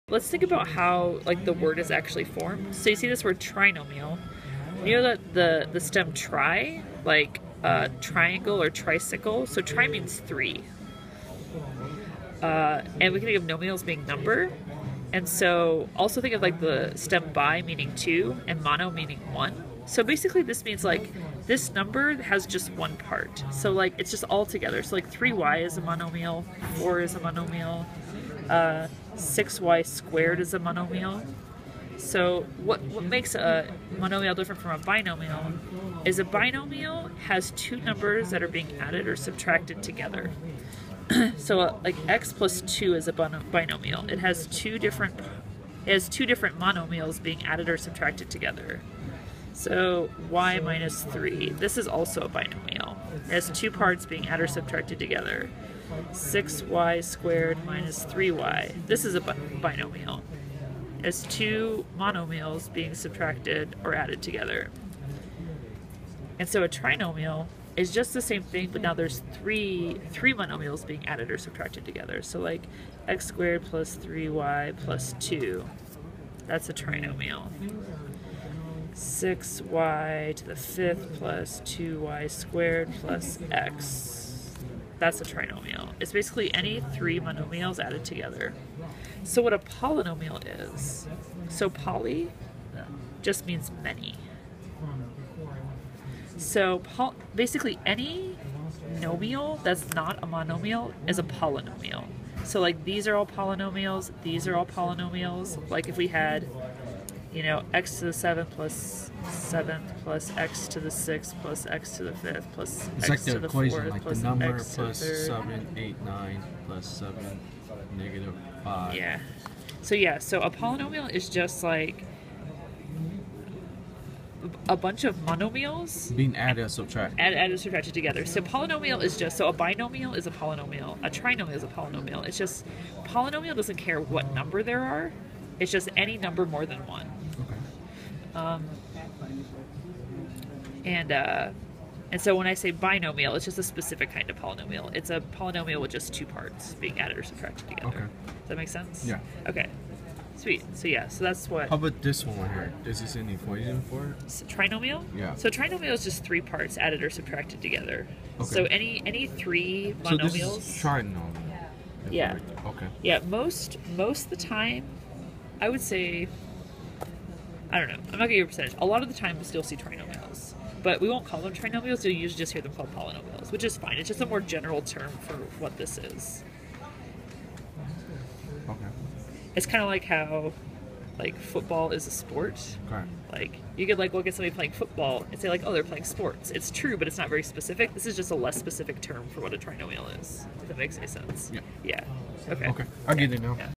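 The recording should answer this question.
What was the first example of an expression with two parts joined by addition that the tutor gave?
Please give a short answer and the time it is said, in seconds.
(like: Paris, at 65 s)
x plus 2, at 42 s.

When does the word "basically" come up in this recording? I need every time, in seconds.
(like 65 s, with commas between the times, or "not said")
20 s, 86 s, 97 s.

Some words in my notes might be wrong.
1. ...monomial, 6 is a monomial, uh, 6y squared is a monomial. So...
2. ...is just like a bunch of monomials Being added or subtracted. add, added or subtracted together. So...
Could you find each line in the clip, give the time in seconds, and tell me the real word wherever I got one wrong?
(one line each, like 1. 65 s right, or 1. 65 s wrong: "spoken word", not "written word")
1. 25 s wrong: "4", not "6"
2. 121 s right.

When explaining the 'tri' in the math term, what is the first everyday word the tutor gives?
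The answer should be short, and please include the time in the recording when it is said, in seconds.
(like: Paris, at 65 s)
triangle, at 8 s.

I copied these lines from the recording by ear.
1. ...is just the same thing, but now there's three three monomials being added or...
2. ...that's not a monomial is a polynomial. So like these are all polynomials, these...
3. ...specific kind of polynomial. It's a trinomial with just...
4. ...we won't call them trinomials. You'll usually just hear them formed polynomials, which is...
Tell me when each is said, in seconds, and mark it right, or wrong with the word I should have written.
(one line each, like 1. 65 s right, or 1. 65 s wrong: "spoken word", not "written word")
1. 67 s right
2. 99 s right
3. 143 s wrong: "polynomial", not "trinomial"
4. 170 s wrong: "called", not "formed".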